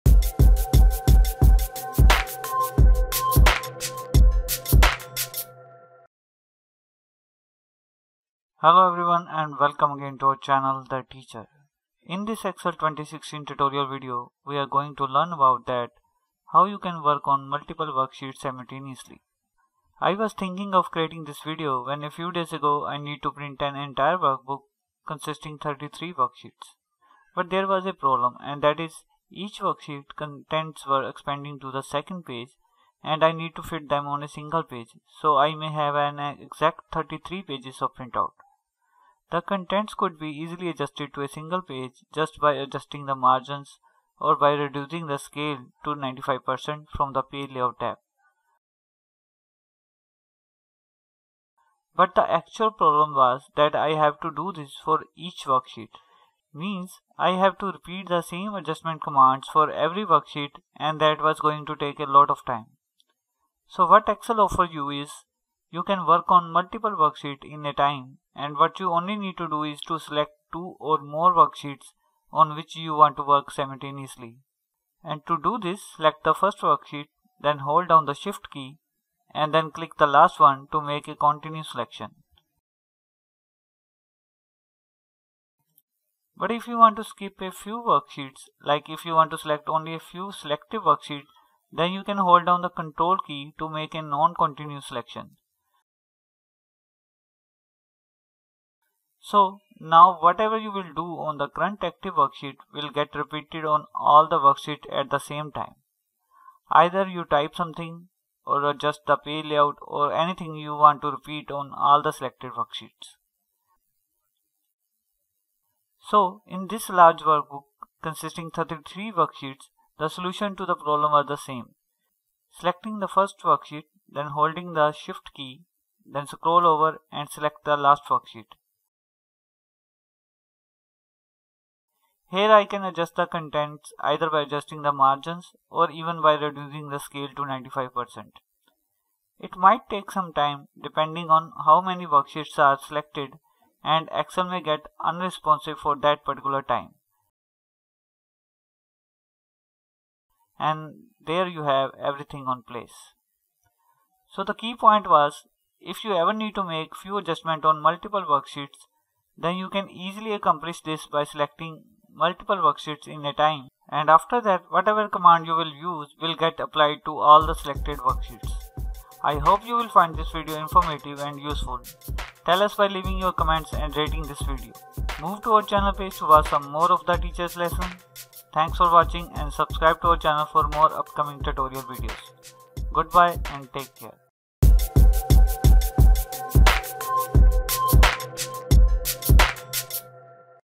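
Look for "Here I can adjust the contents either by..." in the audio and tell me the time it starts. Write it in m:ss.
2:12.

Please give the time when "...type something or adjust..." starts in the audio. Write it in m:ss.
1:47.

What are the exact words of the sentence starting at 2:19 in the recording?
It might take some time depending on how many worksheets are selected and Excel may get unresponsive for that particular time.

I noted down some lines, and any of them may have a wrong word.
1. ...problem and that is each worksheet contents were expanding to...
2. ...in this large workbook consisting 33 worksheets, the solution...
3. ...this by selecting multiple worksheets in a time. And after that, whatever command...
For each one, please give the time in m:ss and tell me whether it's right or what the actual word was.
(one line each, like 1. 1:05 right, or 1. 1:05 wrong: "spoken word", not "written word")
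1. 0:27 right
2. 1:56 right
3. 2:40 right.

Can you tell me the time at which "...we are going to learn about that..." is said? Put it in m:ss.
0:14.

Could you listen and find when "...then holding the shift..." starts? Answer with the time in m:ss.
2:04.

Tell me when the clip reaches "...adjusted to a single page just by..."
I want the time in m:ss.
0:40.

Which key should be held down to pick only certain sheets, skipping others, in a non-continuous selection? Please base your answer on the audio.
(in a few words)
Control.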